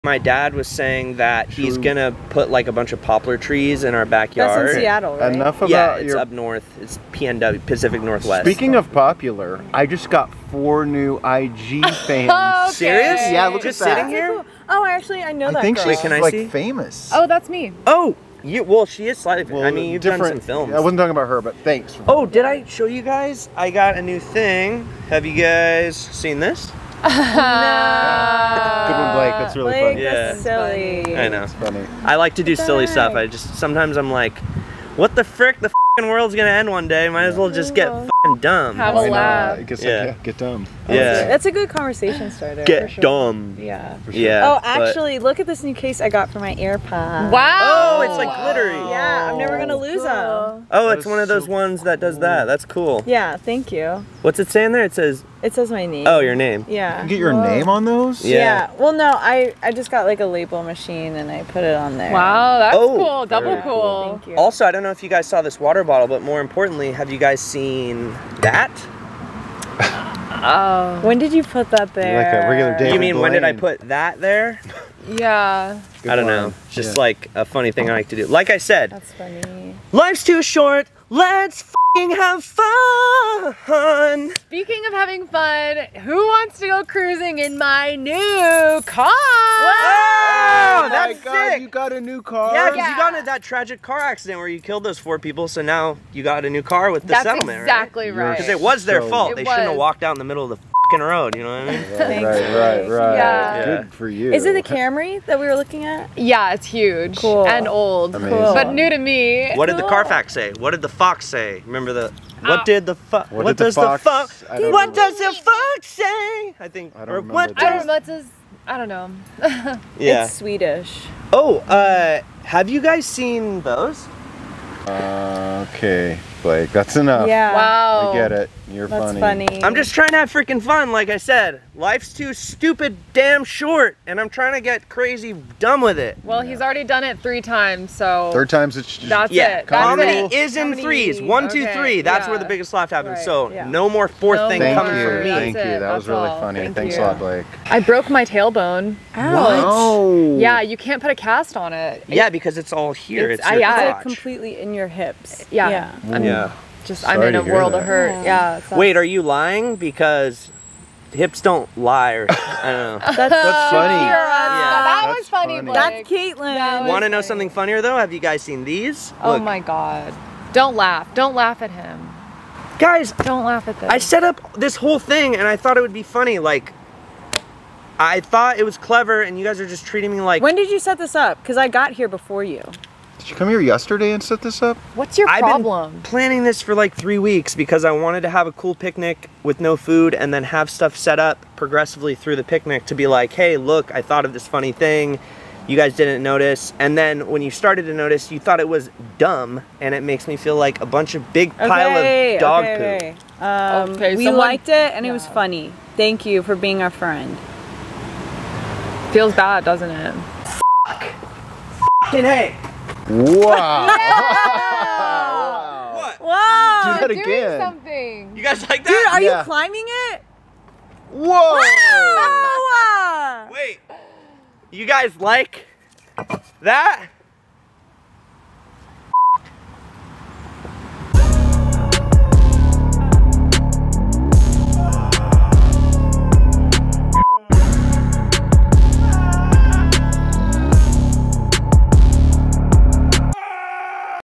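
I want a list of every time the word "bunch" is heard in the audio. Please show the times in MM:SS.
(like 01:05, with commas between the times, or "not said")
00:02, 03:20.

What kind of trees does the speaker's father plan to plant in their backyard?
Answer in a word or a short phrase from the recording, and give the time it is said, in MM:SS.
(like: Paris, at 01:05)
Poplar, at 00:03.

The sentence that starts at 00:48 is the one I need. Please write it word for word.
yeah, I'm never gonna lose cool.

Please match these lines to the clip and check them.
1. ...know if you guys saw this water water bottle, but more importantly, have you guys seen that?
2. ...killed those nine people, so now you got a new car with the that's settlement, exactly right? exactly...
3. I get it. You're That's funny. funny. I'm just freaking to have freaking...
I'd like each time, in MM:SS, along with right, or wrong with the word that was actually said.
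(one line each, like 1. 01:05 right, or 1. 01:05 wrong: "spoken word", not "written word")
1. 01:04 right
2. 01:34 wrong: "four", not "nine"
3. 02:08 wrong: "trying", not "freaking".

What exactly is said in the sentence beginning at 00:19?
Well, I mean, you've different, done some films.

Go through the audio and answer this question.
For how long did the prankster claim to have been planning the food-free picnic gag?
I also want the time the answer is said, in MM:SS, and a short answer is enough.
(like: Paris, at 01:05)
Three weeks, at 03:06.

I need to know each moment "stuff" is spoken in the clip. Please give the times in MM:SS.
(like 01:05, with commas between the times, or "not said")
00:32, 03:10.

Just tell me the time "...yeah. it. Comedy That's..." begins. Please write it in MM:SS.
02:19.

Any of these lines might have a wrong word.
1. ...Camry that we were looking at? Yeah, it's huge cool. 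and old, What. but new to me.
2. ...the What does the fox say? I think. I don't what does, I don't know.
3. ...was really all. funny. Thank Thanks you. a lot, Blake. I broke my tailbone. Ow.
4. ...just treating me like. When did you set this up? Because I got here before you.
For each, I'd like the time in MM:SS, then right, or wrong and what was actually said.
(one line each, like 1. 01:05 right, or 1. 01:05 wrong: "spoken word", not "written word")
1. 01:44 wrong: "Amazing", not "What"
2. 01:54 right
3. 02:25 right
4. 02:59 right.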